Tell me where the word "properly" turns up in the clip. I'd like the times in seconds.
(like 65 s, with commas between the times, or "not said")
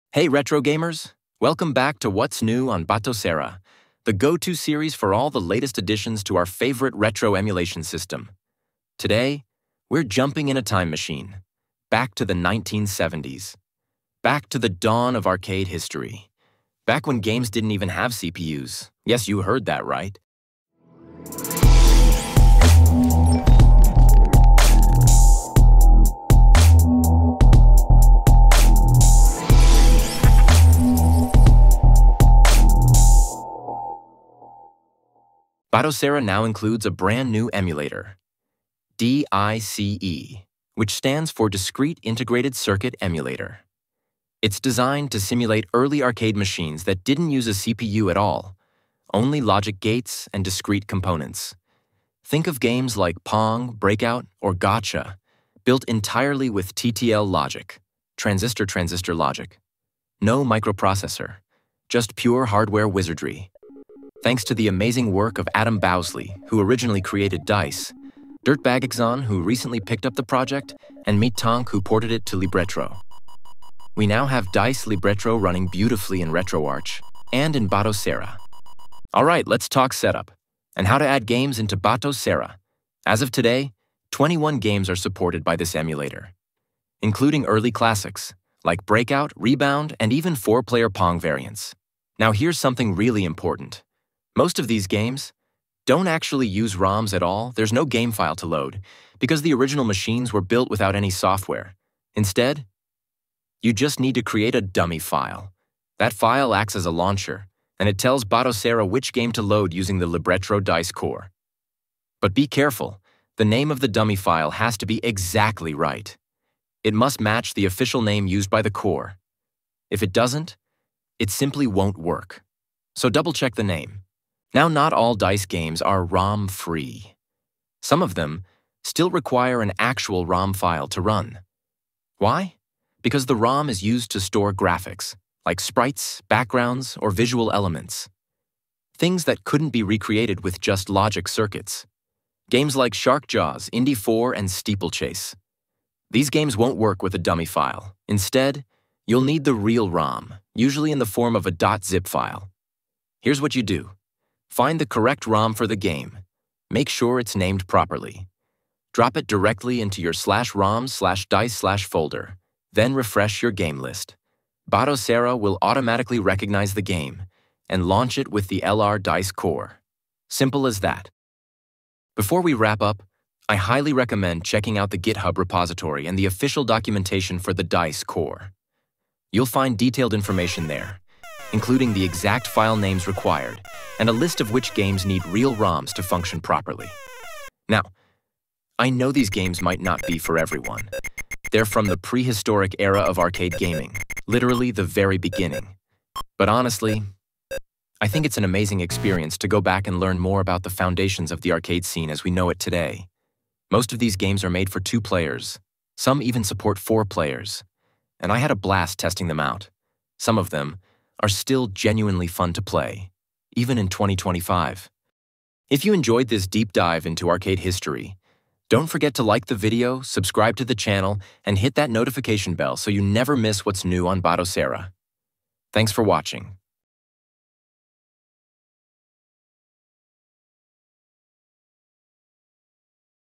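157 s, 186 s.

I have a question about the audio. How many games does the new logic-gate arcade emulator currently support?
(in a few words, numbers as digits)
21.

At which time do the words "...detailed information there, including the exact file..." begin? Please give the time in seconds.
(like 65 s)
179 s.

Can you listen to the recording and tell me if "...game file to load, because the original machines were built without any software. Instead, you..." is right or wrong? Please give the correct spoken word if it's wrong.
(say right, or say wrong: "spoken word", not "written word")
right.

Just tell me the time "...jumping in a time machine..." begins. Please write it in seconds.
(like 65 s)
10 s.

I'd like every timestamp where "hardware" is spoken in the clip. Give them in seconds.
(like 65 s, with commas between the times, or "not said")
62 s.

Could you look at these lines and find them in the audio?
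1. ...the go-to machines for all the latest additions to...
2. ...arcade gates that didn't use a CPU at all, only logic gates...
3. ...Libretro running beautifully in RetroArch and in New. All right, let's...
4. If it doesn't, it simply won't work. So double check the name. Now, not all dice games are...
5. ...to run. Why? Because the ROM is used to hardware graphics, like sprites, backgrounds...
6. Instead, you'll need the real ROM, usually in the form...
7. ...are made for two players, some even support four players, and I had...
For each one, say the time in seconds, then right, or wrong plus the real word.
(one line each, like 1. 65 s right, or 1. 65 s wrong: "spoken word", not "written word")
1. 4 s wrong: "series", not "machines"
2. 46 s wrong: "machines", not "gates"
3. 74 s wrong: "Batocera", not "New"
4. 119 s right
5. 130 s wrong: "store", not "hardware"
6. 148 s right
7. 204 s right.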